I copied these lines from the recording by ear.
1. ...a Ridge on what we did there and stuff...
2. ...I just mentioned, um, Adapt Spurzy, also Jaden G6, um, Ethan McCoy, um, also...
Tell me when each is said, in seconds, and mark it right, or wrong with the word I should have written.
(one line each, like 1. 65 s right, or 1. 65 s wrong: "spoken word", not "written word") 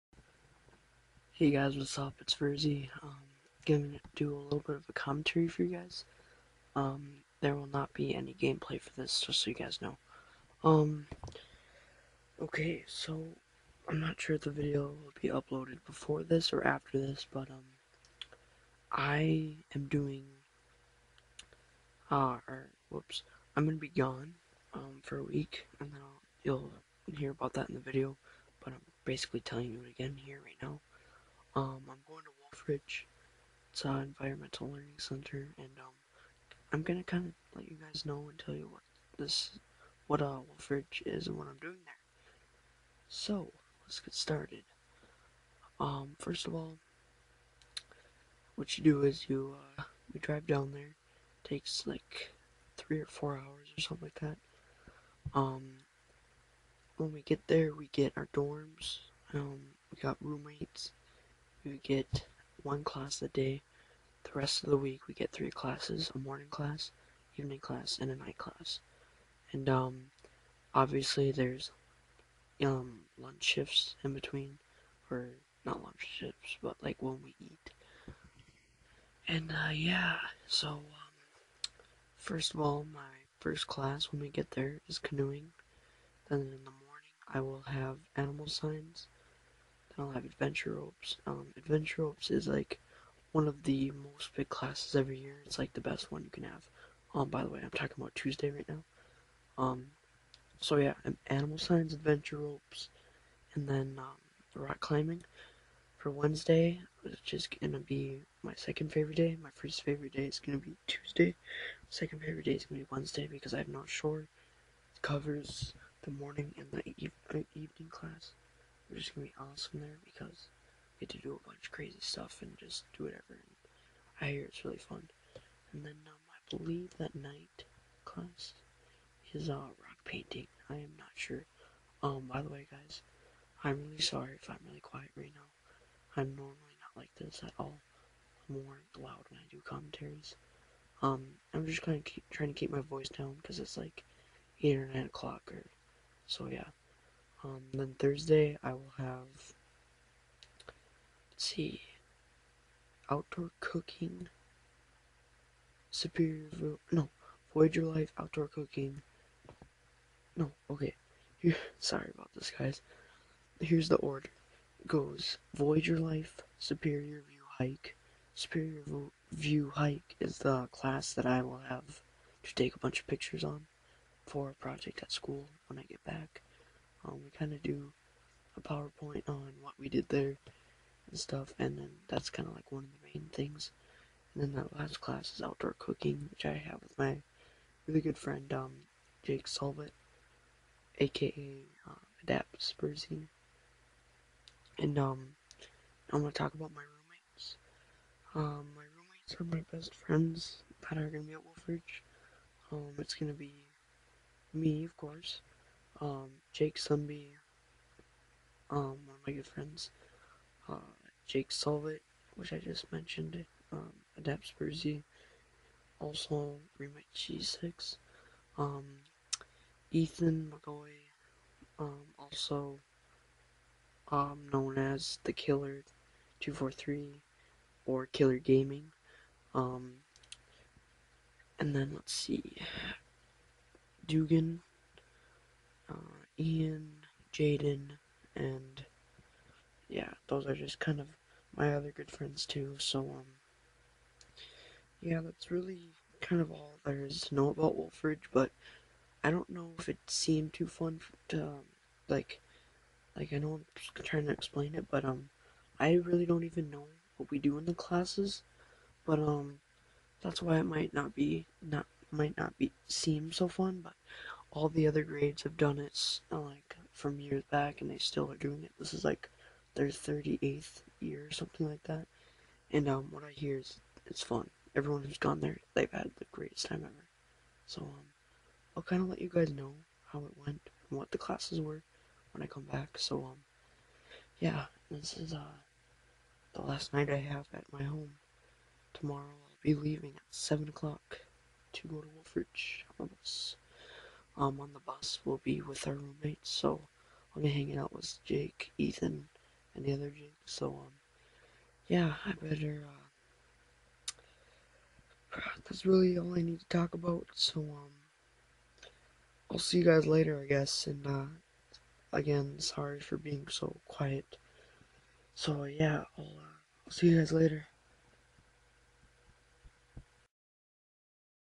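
1. 178 s wrong: "PowerPoint", not "Ridge"
2. 212 s wrong: "Remake", not "Jaden".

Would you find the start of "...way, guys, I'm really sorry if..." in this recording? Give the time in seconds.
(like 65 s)
132 s.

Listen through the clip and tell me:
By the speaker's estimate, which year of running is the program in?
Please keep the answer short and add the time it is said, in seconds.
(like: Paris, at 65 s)
38th, at 269 s.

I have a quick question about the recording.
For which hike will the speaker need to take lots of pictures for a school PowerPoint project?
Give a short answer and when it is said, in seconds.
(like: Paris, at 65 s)
Superior view hike, at 166 s.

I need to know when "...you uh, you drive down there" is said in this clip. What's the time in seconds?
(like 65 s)
49 s.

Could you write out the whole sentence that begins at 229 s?
Um, and then let's see, Dugan, uh, Ian, Jaden, and yeah, those are just kind of my other good friends too.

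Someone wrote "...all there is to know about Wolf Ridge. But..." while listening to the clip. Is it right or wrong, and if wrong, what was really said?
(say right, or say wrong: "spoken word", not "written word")
right.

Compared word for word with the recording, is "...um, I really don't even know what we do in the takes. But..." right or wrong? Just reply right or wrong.
wrong.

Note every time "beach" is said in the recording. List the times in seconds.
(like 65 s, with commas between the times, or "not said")
not said.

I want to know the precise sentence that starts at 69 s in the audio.
And um, obviously, there's um lunch shifts in between, or not lunch shifts, but like when we eat.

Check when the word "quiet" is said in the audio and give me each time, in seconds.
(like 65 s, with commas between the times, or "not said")
134 s, 313 s.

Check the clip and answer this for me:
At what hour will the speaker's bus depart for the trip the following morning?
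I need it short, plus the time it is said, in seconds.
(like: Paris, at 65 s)
7 o'clock, at 290 s.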